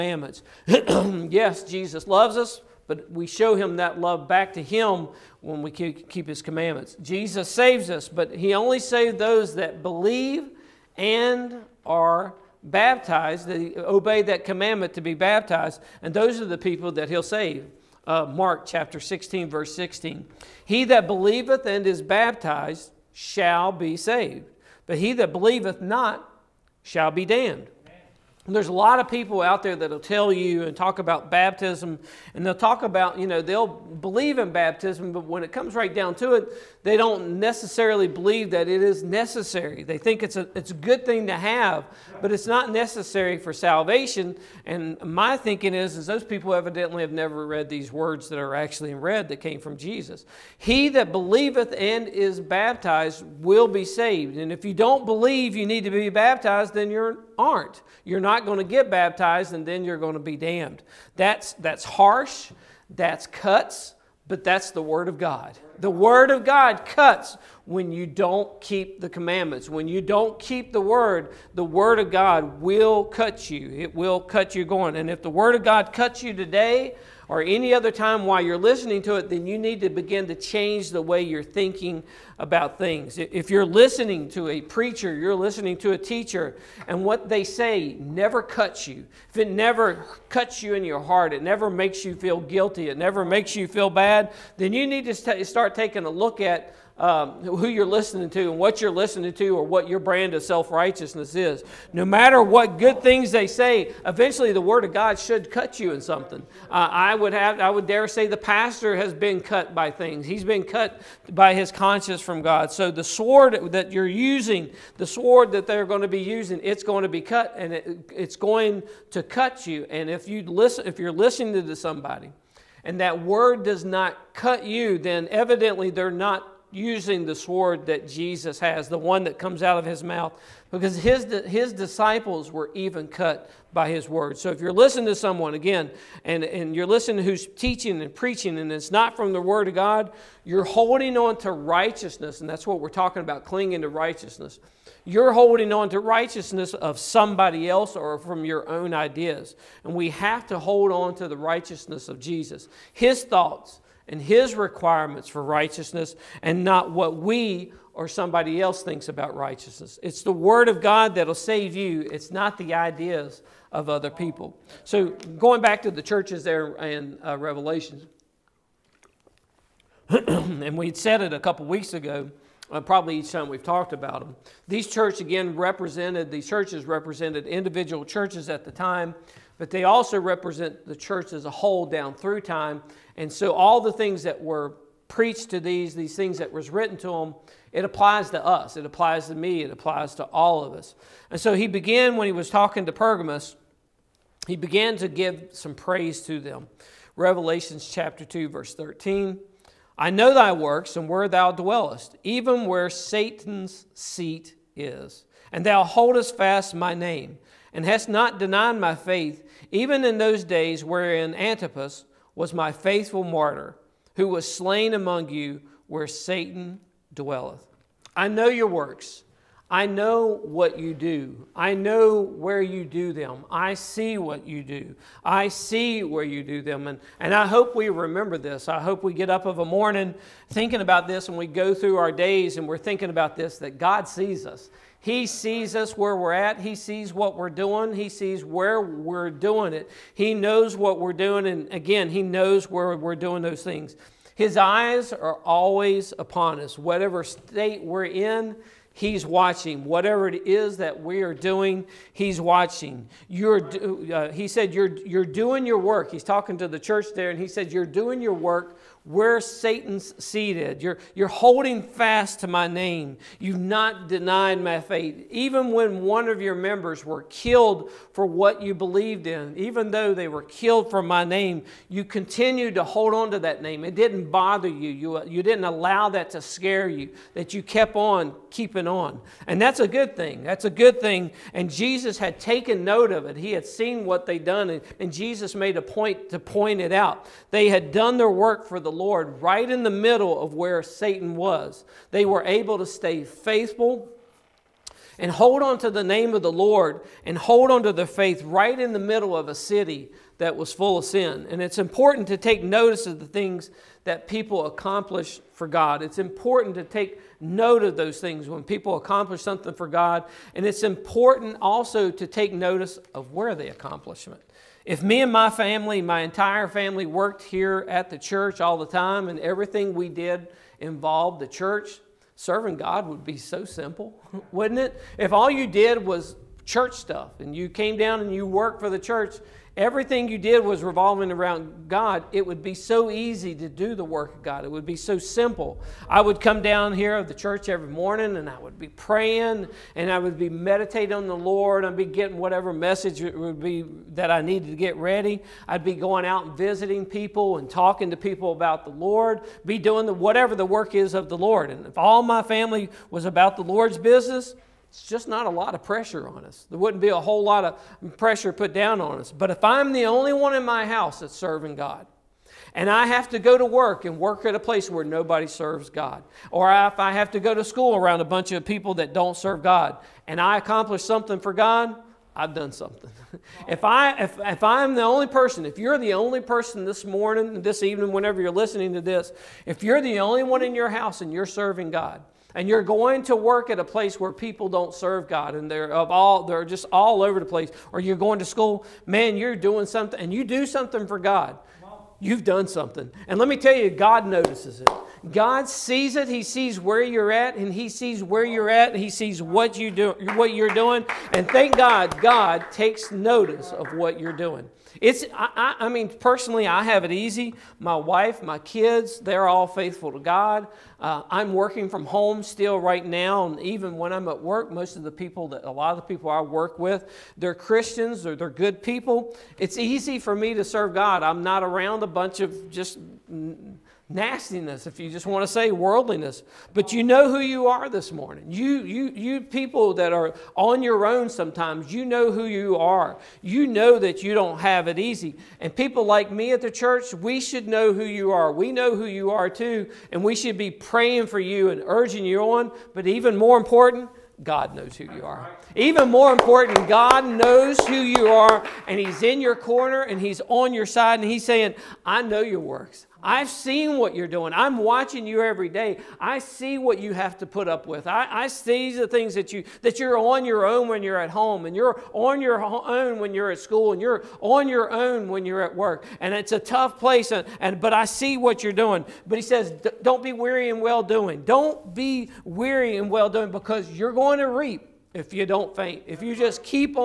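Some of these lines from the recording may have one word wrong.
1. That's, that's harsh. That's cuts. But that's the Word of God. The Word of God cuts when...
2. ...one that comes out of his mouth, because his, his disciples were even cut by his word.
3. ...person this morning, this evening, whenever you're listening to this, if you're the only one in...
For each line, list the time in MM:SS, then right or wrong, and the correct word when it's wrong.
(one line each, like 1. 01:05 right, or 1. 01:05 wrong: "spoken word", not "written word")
1. 01:01 right
2. 02:08 right
3. 06:16 right.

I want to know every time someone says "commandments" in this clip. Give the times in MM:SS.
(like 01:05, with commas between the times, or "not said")
00:06, 00:14, 01:09.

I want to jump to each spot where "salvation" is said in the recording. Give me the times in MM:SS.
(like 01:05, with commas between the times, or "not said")
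00:43.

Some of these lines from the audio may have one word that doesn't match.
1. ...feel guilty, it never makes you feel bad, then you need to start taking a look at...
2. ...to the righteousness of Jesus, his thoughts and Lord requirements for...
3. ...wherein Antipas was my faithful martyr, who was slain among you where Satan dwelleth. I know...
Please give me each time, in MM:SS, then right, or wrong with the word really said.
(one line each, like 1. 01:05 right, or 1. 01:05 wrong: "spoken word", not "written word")
1. 01:32 right
2. 02:31 wrong: "His", not "Lord"
3. 03:30 right.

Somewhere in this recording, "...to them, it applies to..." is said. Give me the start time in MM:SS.
03:06.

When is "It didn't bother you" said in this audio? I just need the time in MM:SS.
04:33.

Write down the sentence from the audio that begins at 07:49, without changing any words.
But he says, don't be weary in well doing.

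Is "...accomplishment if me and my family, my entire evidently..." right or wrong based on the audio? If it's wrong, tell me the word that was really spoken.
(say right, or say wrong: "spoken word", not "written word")
wrong: "family", not "evidently".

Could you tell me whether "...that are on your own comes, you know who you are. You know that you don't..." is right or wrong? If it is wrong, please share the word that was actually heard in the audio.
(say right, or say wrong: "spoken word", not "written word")
wrong: "sometimes", not "comes".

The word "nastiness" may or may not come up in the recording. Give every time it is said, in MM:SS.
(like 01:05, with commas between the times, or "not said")
07:04.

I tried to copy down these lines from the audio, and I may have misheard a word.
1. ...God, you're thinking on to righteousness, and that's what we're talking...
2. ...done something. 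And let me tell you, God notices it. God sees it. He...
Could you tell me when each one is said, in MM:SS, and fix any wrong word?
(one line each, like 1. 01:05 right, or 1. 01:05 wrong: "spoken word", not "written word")
1. 02:19 wrong: "holding", not "thinking"
2. 06:32 right.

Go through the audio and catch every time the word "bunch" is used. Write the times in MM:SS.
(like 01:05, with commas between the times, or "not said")
06:08, 07:02.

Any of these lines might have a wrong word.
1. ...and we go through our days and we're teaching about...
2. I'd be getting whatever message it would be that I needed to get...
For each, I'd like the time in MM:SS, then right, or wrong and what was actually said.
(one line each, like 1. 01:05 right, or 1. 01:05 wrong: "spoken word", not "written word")
1. 03:51 wrong: "thinking", not "teaching"
2. 05:41 right.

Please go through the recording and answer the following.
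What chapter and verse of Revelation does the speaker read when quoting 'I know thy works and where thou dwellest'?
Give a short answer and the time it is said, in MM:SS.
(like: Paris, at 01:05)
Chapter 2, verse 13, at 03:17.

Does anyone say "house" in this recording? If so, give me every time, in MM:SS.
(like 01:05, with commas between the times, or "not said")
06:00, 06:20.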